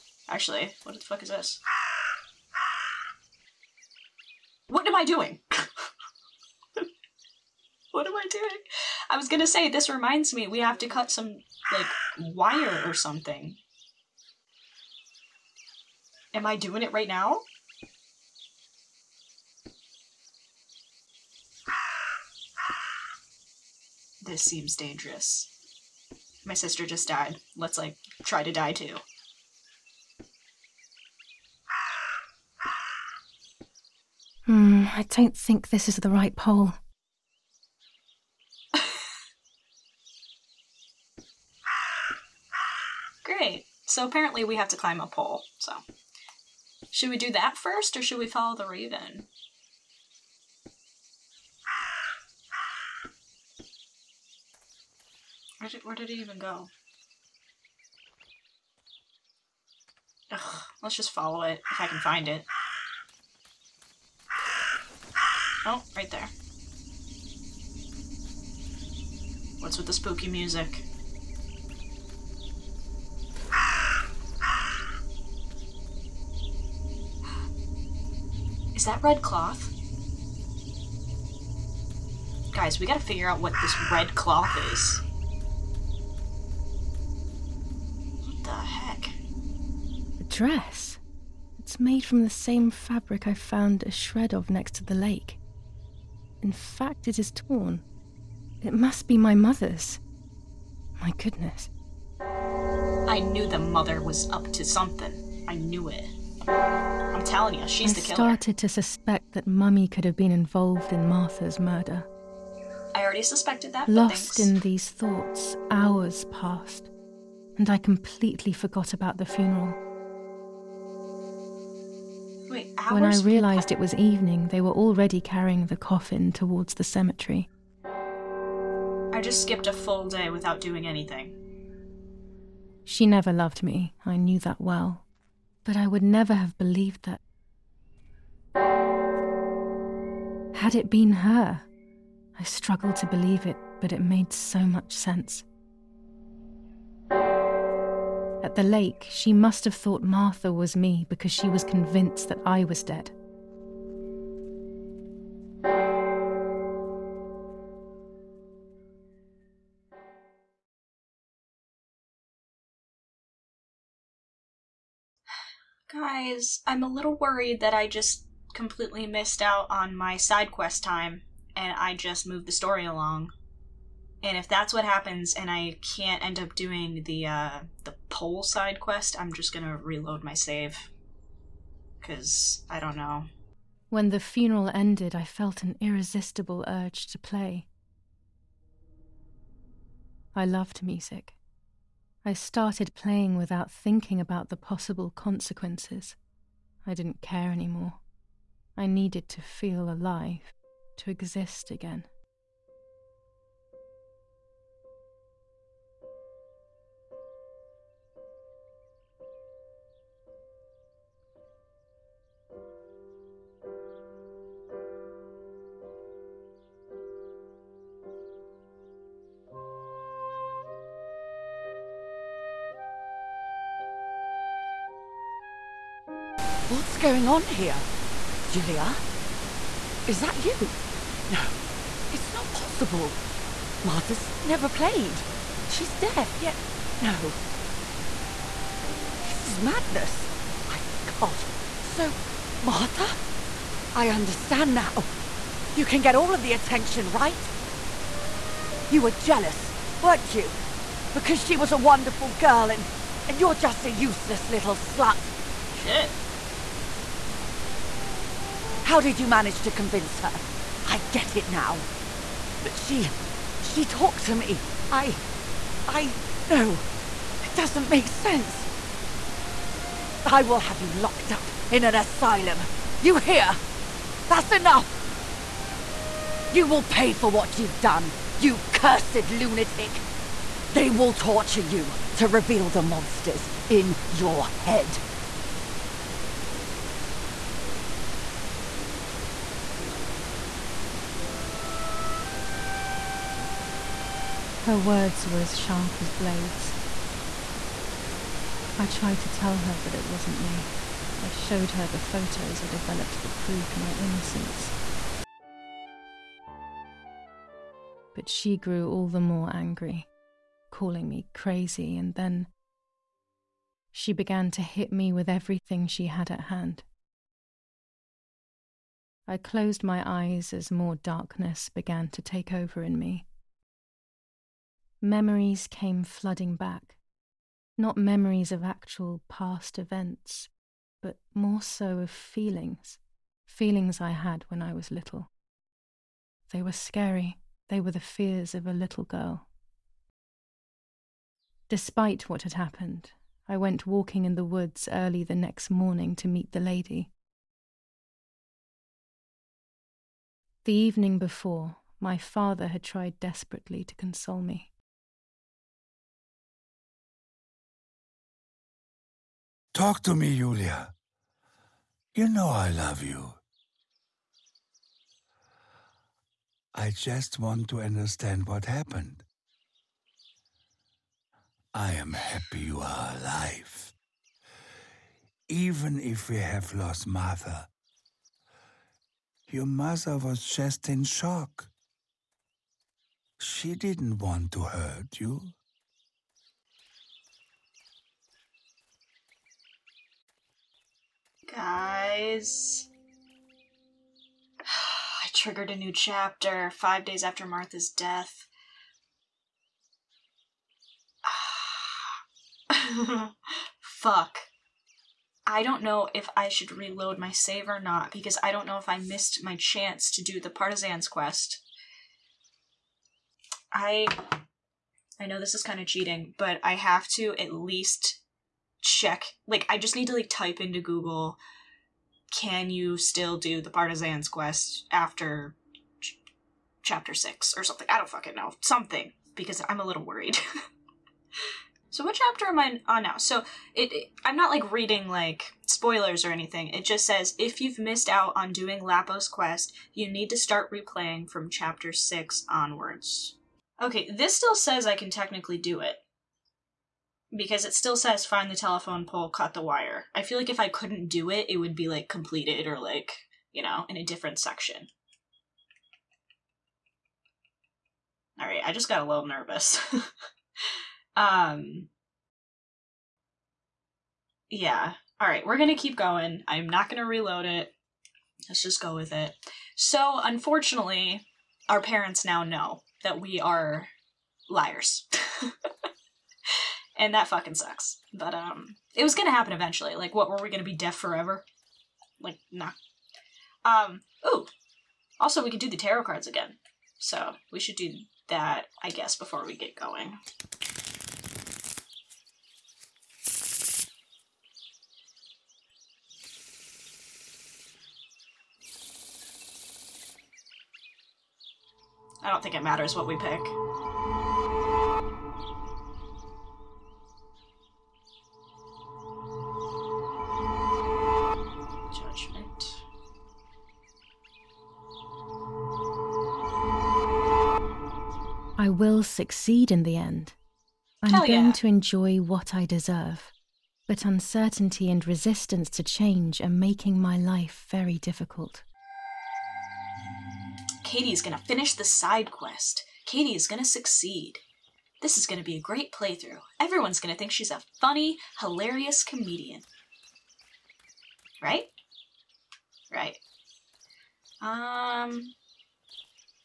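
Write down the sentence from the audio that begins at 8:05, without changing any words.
Also, we could do the tarot cards again, so we should do that, I guess, before we get going.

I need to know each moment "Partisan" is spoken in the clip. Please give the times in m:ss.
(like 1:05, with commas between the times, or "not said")
6:50, 7:03.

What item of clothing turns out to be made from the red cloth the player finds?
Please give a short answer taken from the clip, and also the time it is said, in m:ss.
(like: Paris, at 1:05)
A dress, at 1:30.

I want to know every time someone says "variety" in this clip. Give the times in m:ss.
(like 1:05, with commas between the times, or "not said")
not said.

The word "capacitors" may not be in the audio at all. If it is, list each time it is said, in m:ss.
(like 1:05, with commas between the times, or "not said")
not said.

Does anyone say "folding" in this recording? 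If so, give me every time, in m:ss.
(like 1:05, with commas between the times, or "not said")
not said.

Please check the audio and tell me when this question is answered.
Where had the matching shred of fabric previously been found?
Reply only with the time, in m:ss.
1:34.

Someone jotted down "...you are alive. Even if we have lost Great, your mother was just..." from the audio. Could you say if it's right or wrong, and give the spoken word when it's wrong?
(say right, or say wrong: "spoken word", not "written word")
wrong: "Martha", not "Great".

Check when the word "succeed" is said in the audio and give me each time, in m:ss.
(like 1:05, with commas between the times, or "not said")
8:39, 8:53.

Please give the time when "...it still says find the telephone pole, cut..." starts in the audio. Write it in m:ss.
7:27.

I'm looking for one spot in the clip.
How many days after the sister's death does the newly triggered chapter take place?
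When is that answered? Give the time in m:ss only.
6:36.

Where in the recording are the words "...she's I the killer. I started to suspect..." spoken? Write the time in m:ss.
1:47.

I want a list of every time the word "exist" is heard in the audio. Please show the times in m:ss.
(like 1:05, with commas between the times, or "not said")
3:21.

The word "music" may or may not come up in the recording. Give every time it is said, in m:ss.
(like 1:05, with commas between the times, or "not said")
1:10, 3:10.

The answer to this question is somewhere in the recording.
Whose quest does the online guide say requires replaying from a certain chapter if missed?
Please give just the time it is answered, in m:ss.
7:18.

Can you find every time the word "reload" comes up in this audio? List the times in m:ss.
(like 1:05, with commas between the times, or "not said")
2:59, 6:46, 7:47.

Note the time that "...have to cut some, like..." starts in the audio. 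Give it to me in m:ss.
0:10.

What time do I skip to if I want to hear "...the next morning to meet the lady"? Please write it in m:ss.
5:45.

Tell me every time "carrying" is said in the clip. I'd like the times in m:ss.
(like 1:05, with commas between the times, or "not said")
2:05.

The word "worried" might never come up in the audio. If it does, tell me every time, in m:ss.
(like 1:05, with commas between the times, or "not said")
2:47, 7:10.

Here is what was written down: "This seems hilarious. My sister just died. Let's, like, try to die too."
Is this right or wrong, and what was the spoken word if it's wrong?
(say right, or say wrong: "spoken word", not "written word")
wrong: "dangerous", not "hilarious".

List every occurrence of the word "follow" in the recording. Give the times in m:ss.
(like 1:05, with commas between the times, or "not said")
0:48, 1:01.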